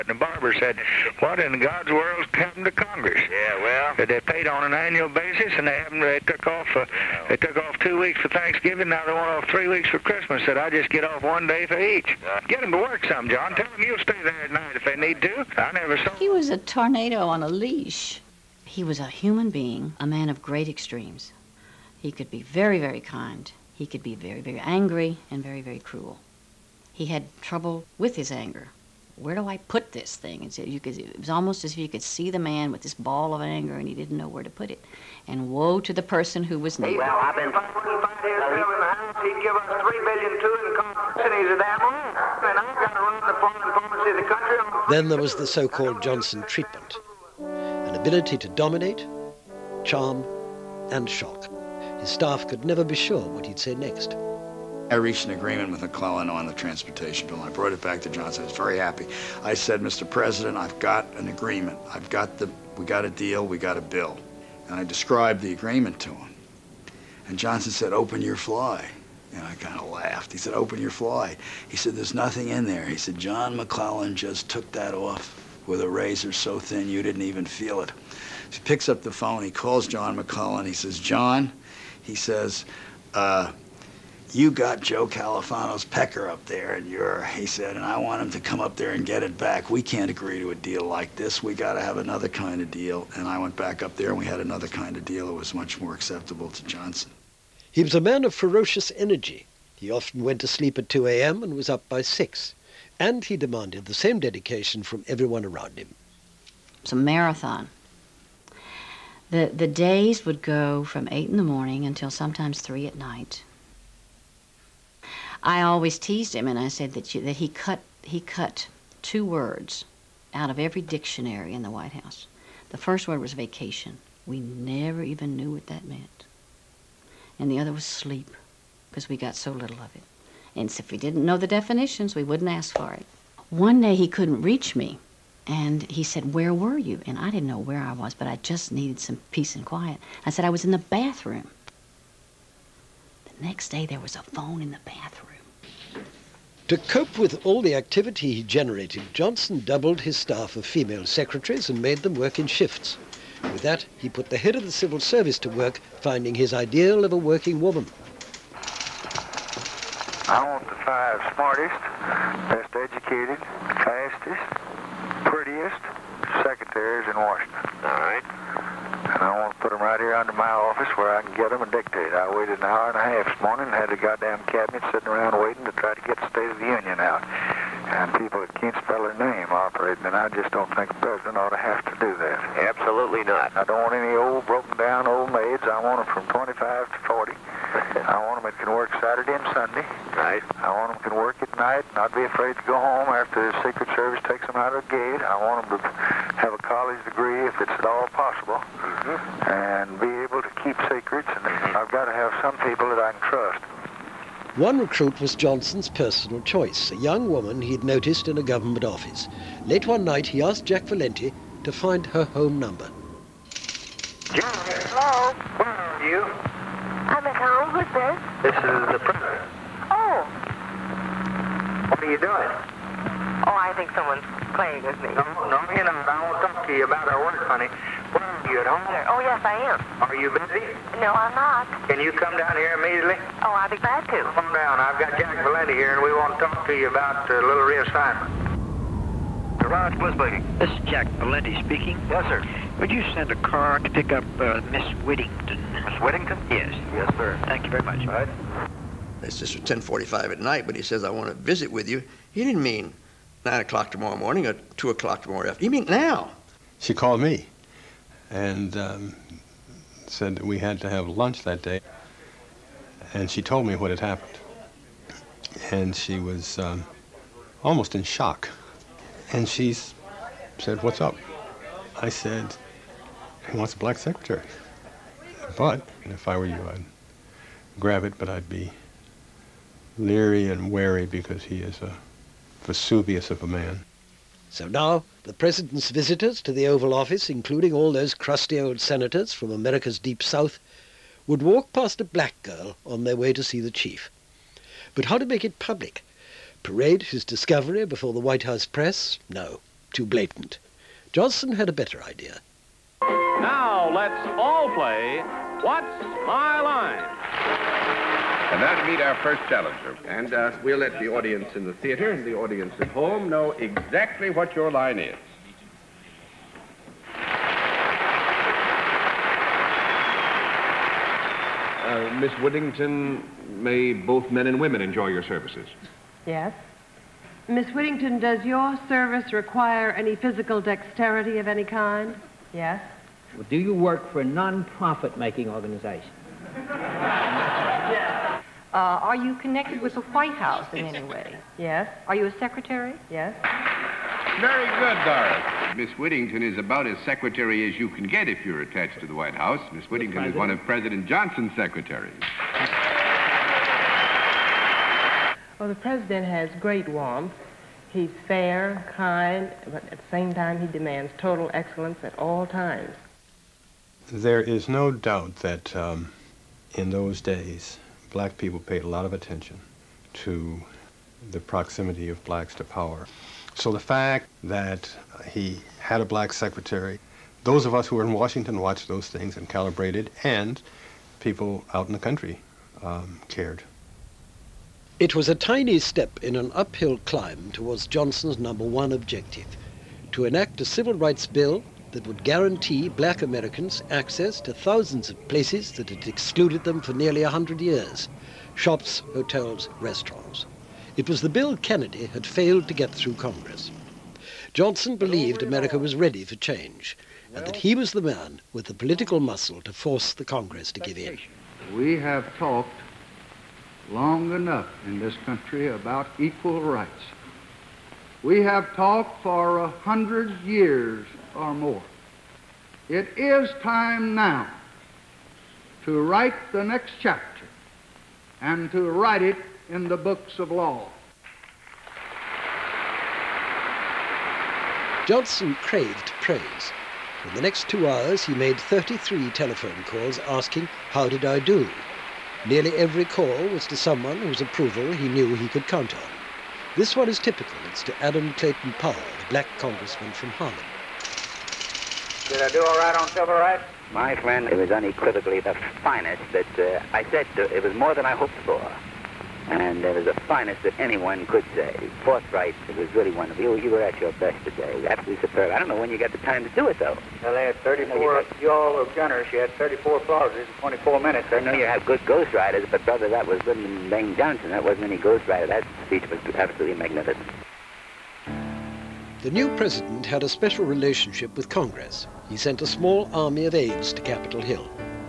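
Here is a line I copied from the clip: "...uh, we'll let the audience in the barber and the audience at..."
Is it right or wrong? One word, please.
wrong.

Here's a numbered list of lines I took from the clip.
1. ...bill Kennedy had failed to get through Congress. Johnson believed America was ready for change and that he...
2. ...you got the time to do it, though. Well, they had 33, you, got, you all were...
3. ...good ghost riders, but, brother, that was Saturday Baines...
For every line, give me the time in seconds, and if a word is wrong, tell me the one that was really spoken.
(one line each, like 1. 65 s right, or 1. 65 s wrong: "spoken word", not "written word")
1. 401 s right
2. 465 s wrong: "34", not "33"
3. 471 s wrong: "Lyndon", not "Saturday".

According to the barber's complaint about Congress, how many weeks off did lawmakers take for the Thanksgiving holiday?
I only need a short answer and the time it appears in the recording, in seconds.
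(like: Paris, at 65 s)
2, at 7 s.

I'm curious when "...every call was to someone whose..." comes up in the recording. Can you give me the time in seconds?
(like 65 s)
442 s.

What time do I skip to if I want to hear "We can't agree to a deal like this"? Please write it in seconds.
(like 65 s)
89 s.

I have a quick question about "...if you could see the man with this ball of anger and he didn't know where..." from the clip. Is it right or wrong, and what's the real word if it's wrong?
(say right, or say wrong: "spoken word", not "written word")
right.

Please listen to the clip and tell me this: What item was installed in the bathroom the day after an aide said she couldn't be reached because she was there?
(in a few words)
a phone.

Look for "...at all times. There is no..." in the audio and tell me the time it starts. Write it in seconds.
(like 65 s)
362 s.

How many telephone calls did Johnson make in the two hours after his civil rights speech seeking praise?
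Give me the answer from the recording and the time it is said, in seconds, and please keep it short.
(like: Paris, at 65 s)
33, at 438 s.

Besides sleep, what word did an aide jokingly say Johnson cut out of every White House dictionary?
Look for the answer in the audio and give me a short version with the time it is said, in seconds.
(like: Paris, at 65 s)
vacation, at 123 s.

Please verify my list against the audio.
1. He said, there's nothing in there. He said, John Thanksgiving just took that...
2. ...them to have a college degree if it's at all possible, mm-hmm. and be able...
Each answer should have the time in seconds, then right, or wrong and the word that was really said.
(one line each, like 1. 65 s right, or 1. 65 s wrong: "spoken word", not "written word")
1. 71 s wrong: "McClellan", not "Thanksgiving"
2. 195 s right.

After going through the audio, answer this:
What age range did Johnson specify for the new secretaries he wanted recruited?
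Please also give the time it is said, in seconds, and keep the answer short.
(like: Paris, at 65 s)
25 to 40, at 186 s.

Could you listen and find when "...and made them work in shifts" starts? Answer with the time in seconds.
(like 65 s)
151 s.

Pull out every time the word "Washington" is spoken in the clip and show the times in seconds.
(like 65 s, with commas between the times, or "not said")
167 s, 378 s.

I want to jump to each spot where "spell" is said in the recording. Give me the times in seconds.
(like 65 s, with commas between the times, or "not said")
178 s.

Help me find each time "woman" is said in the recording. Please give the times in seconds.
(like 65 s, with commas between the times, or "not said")
157 s, 207 s.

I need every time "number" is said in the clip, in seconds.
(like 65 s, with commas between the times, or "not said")
212 s, 388 s.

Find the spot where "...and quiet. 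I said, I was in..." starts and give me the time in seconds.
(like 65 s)
139 s.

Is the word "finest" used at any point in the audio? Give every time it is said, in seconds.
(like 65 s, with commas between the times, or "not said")
455 s, 460 s.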